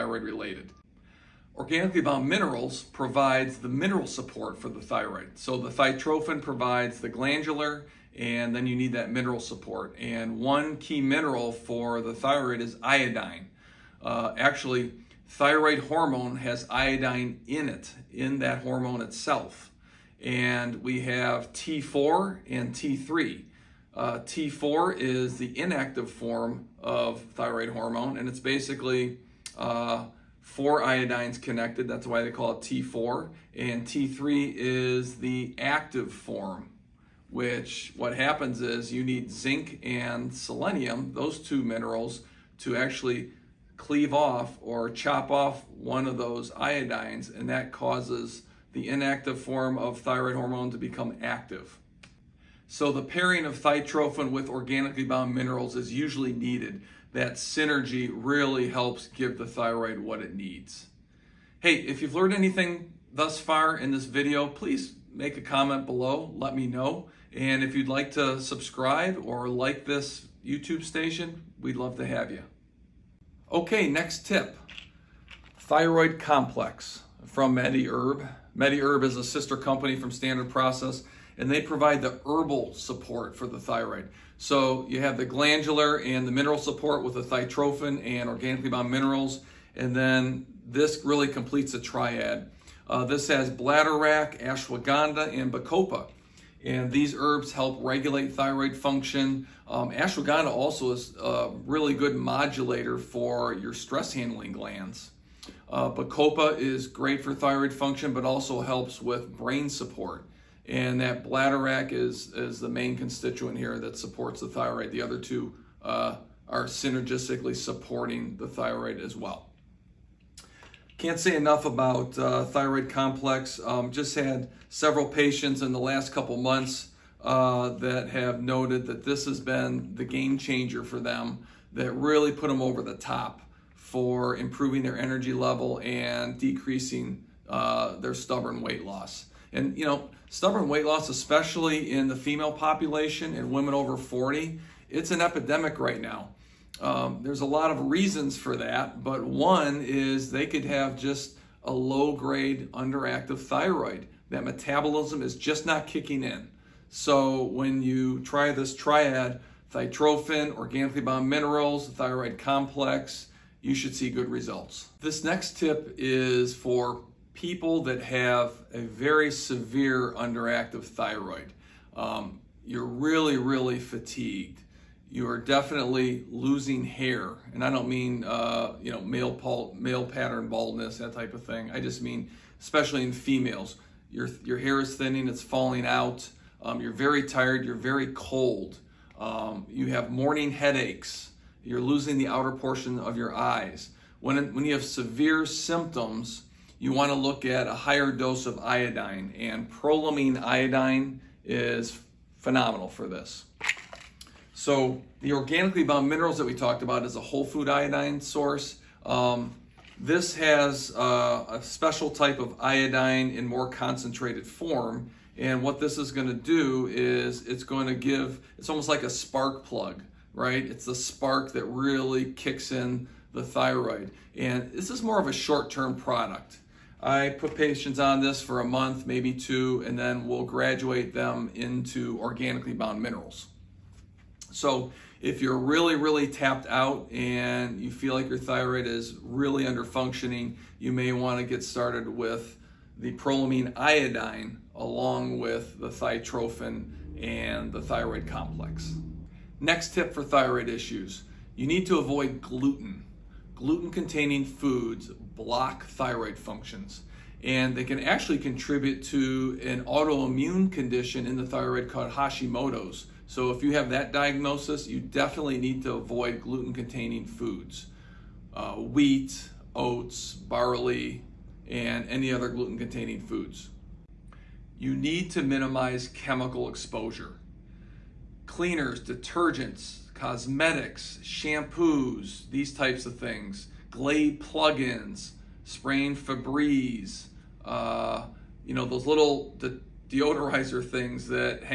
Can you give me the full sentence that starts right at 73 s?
Okay, next tip, thyroid complex from MediHerb.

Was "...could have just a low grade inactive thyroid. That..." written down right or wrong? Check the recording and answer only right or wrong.
wrong.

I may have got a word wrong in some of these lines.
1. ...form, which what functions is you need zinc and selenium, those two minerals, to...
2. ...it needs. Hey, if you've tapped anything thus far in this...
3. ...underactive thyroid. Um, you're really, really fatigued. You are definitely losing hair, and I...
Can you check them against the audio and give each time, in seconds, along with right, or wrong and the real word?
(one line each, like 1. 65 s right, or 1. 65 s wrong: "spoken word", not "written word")
1. 36 s wrong: "happens", not "functions"
2. 60 s wrong: "learned", not "tapped"
3. 170 s right.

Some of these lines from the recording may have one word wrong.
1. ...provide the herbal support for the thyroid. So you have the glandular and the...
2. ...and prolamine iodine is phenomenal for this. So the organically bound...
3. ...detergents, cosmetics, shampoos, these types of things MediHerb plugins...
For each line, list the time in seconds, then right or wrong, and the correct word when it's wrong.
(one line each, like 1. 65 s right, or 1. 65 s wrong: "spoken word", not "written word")
1. 81 s right
2. 199 s right
3. 278 s wrong: "Glade", not "MediHerb".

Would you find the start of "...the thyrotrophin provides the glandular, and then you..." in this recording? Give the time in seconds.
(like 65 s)
5 s.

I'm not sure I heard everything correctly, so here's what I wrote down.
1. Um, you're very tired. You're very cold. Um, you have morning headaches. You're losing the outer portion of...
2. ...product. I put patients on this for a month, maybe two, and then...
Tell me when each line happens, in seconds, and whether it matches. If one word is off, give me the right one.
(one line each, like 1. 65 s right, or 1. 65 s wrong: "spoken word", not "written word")
1. 186 s right
2. 225 s right.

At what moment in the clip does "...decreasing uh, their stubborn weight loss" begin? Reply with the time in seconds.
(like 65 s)
136 s.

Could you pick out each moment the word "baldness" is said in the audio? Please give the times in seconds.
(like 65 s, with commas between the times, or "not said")
180 s.